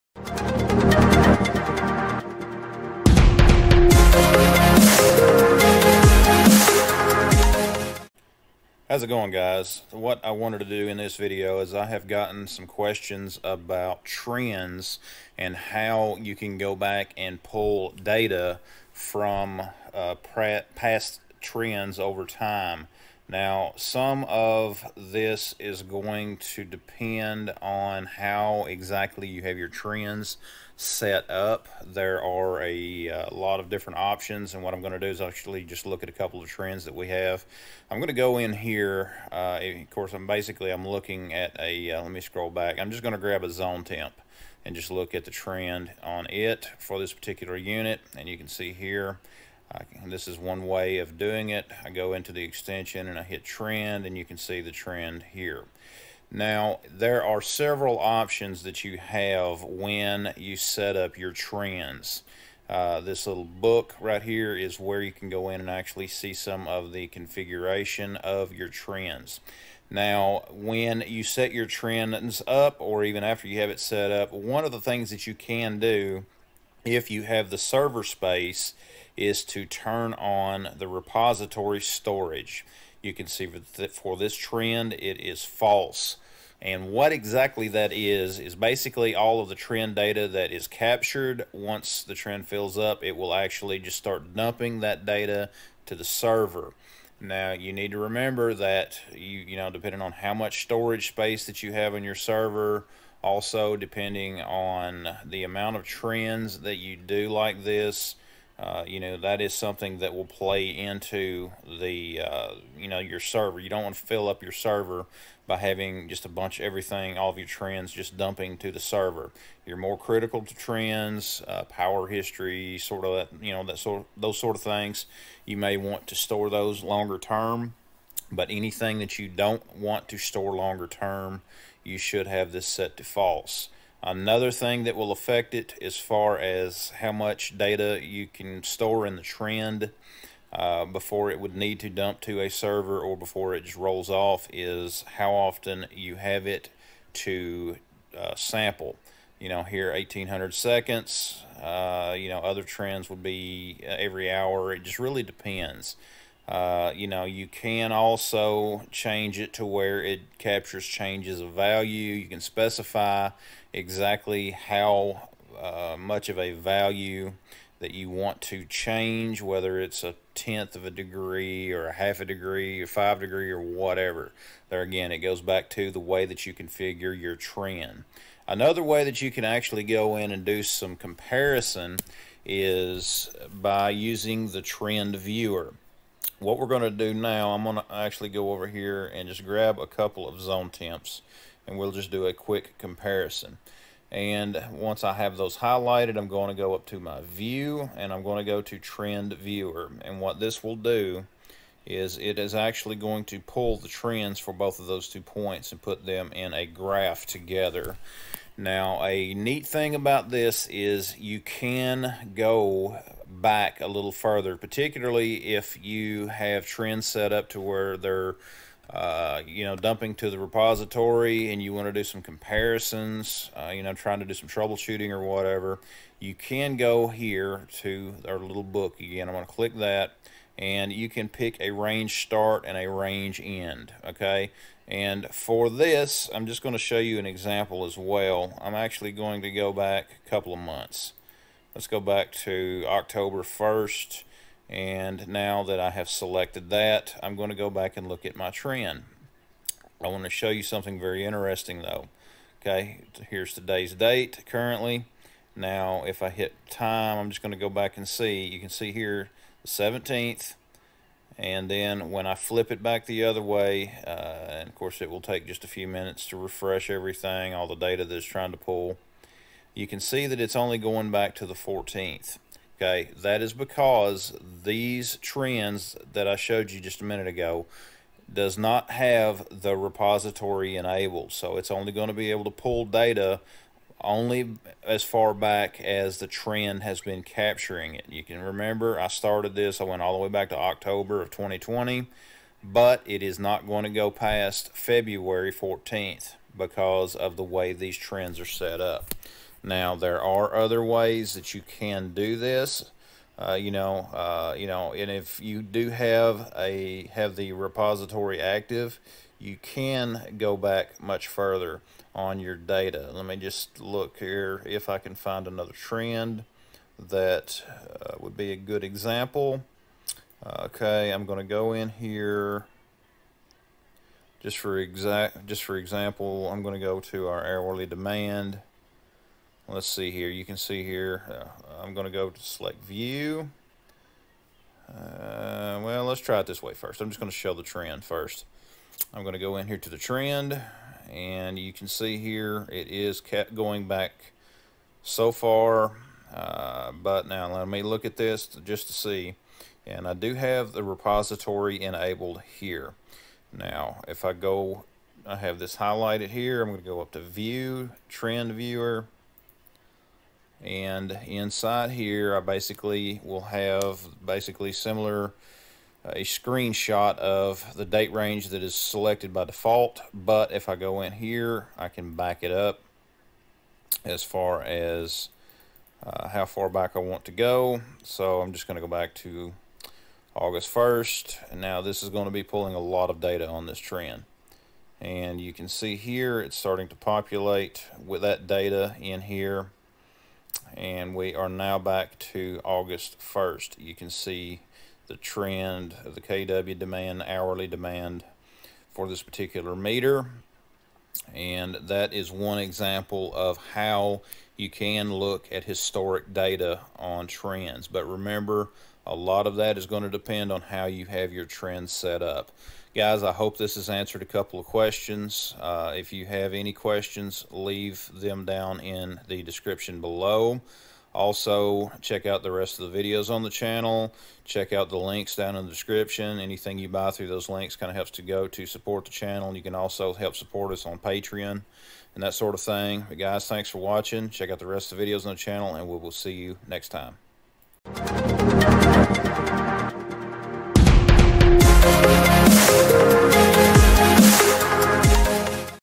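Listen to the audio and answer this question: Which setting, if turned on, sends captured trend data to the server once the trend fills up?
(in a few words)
repository storage.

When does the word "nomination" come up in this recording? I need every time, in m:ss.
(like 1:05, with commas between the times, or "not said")
not said.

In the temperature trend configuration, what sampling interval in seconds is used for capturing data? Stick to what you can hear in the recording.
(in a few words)
1800.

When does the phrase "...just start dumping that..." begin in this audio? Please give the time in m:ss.
1:33.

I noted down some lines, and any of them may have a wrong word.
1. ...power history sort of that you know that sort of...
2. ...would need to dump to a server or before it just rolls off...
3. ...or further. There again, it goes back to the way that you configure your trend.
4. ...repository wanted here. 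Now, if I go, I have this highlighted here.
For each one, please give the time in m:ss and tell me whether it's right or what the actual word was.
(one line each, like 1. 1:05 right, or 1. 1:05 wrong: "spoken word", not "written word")
1. 2:01 right
2. 2:21 right
3. 2:53 wrong: "whatever", not "further"
4. 5:50 wrong: "enabled", not "wanted".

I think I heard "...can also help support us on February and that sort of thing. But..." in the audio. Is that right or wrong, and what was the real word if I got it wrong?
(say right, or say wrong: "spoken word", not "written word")
wrong: "Patreon", not "February".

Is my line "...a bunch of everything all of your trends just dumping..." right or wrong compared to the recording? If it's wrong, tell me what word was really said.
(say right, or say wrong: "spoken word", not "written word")
right.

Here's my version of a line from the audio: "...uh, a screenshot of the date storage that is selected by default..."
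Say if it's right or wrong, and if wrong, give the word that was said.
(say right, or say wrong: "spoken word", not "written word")
wrong: "range", not "storage".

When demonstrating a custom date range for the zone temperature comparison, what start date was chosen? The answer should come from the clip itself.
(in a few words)
October 1st.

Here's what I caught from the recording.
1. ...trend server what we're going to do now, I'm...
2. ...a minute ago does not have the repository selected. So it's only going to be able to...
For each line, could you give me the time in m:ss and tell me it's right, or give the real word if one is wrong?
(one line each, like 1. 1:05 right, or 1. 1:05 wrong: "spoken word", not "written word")
1. 3:04 wrong: "viewer", not "server"
2. 4:37 wrong: "enabled", not "selected".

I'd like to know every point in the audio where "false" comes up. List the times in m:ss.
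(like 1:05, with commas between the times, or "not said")
1:25, 2:13.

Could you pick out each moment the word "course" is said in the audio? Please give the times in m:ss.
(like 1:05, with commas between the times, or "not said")
0:39, 4:24.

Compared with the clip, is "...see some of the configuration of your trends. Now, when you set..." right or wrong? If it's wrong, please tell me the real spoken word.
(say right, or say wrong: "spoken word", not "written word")
right.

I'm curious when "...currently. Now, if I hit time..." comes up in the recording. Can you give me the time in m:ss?
4:14.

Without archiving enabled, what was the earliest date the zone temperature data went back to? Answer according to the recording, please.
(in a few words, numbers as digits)
February 14th.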